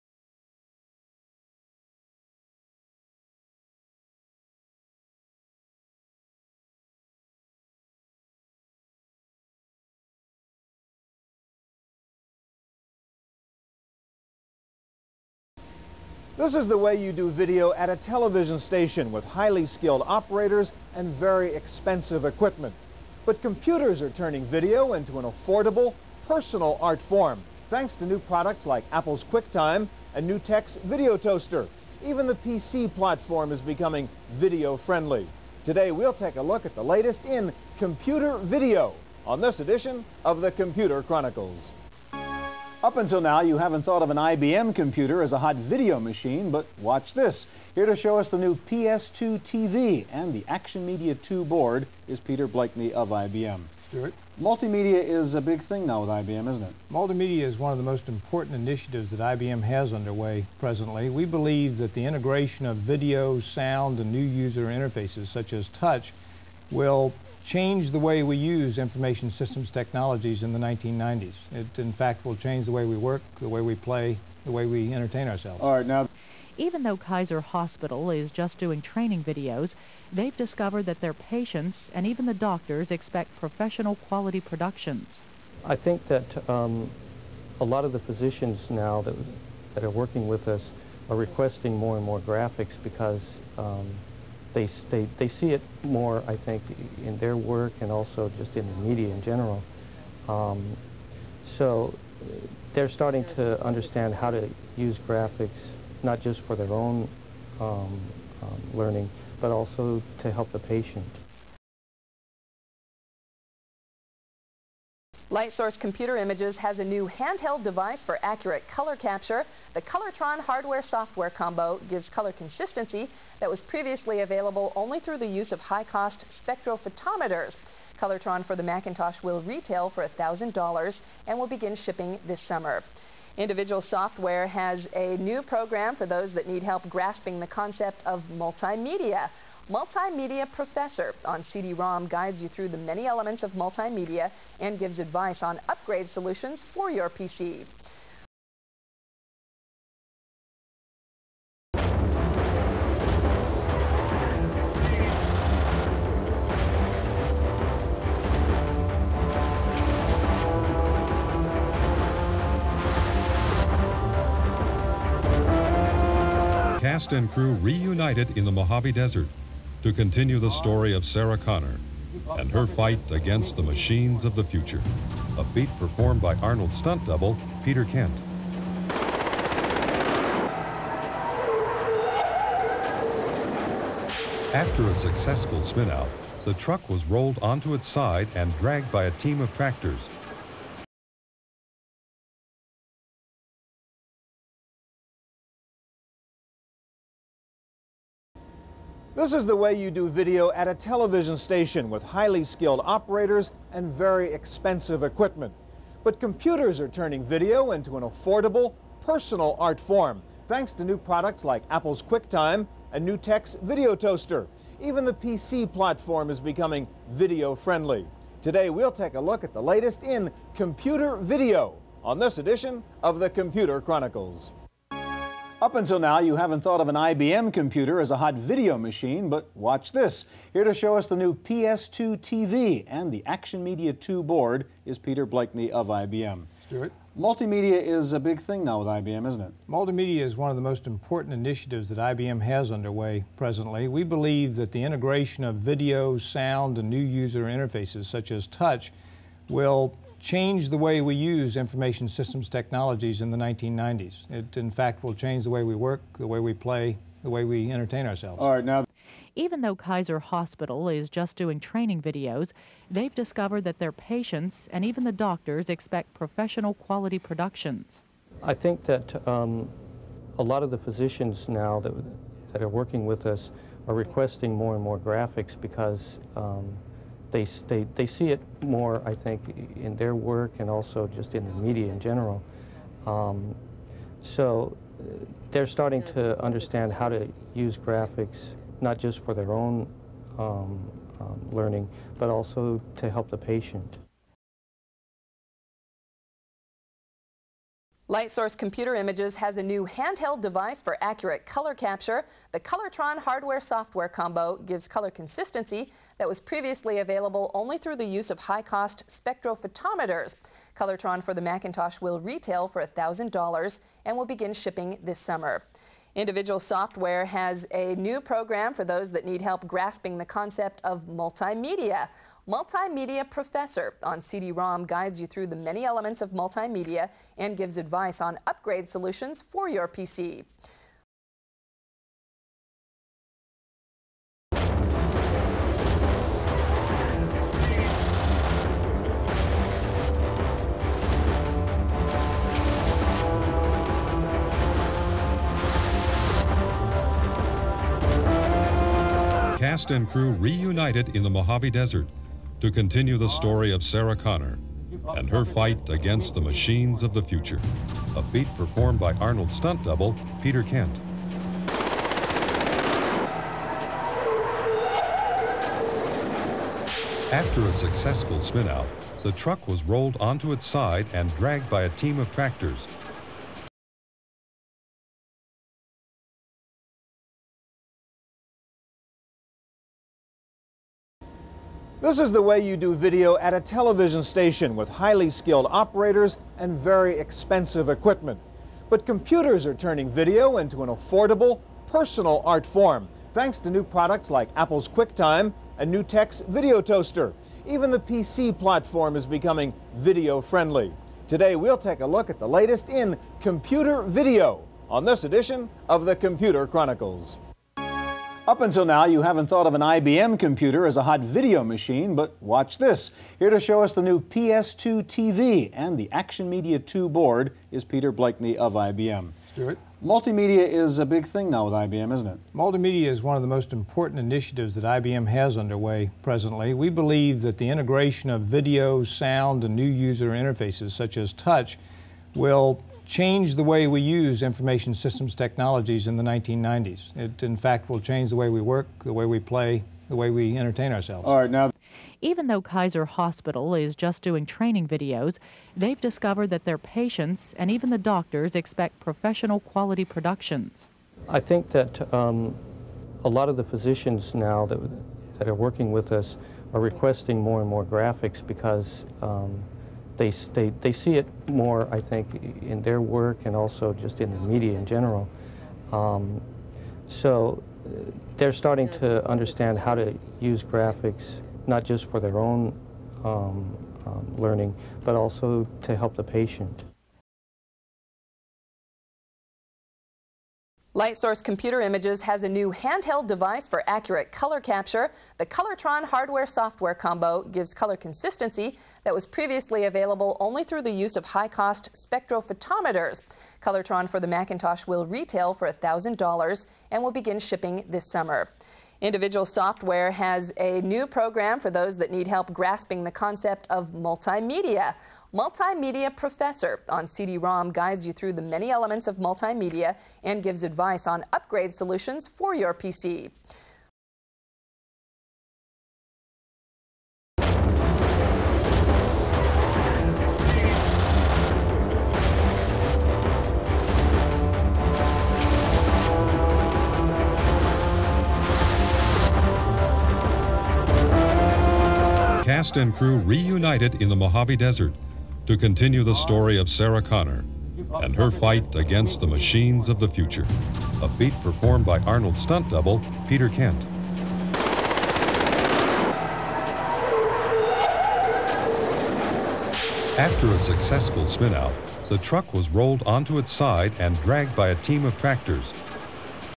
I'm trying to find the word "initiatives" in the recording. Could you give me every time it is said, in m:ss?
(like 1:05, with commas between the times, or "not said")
0:58, 4:01, 7:04.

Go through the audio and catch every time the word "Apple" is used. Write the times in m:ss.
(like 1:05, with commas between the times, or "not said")
0:28, 3:31, 6:34.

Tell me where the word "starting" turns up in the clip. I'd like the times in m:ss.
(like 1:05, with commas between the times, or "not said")
1:42, 4:45, 7:48.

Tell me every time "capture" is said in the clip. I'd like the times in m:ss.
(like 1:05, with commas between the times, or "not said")
1:58, 5:01, 8:04.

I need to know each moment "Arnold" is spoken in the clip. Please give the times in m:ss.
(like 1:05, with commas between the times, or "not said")
2:56, 5:59, 9:02.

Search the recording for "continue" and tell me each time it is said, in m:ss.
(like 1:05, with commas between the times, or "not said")
2:49, 5:52, 8:55.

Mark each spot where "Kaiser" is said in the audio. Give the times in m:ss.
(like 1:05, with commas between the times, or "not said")
1:16, 4:19, 7:22.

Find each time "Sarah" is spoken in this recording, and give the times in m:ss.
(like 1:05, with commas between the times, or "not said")
2:51, 5:53, 8:56.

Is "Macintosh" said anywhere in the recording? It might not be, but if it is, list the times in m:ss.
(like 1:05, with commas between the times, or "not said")
2:08, 5:11, 8:14.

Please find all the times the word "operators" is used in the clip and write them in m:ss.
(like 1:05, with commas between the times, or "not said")
0:20, 3:22, 6:25.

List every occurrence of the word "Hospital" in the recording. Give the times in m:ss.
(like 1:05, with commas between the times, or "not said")
1:17, 4:20, 7:23.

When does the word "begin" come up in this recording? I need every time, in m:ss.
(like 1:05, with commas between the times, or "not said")
2:11, 5:14, 8:17.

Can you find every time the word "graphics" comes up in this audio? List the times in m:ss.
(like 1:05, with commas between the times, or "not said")
1:32, 1:45, 4:34, 4:47, 7:37, 7:50.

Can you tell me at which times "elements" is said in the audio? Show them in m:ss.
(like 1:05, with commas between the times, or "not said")
2:23, 5:25, 8:28.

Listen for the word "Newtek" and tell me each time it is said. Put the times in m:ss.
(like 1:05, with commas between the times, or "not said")
0:30, 3:33, 6:35.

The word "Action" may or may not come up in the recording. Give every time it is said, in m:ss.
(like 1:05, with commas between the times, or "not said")
0:50, 3:53, 6:56.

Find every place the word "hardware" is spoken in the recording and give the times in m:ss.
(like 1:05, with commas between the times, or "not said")
2:00, 5:03, 8:06.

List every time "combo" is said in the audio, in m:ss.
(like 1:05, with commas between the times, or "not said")
2:01, 5:04, 8:06.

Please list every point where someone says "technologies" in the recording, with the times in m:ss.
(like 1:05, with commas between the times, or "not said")
1:09, 4:12, 7:15.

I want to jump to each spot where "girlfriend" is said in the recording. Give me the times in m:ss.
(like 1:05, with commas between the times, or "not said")
not said.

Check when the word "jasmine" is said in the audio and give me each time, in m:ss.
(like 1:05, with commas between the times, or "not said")
not said.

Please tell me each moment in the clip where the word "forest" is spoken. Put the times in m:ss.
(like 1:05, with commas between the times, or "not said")
not said.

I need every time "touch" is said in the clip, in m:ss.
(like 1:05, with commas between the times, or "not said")
1:05, 4:08, 7:11.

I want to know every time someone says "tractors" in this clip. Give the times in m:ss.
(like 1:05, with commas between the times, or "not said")
3:09, 6:12, 9:15.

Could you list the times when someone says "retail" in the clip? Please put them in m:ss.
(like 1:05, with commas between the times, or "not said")
2:09, 5:12, 8:15.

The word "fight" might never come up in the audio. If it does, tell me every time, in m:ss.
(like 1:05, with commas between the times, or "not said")
2:52, 5:55, 8:58.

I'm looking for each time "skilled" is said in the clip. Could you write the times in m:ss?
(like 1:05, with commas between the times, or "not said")
0:19, 3:22, 6:25.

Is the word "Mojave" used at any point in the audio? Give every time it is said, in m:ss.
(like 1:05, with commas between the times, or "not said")
2:48, 5:51, 8:54.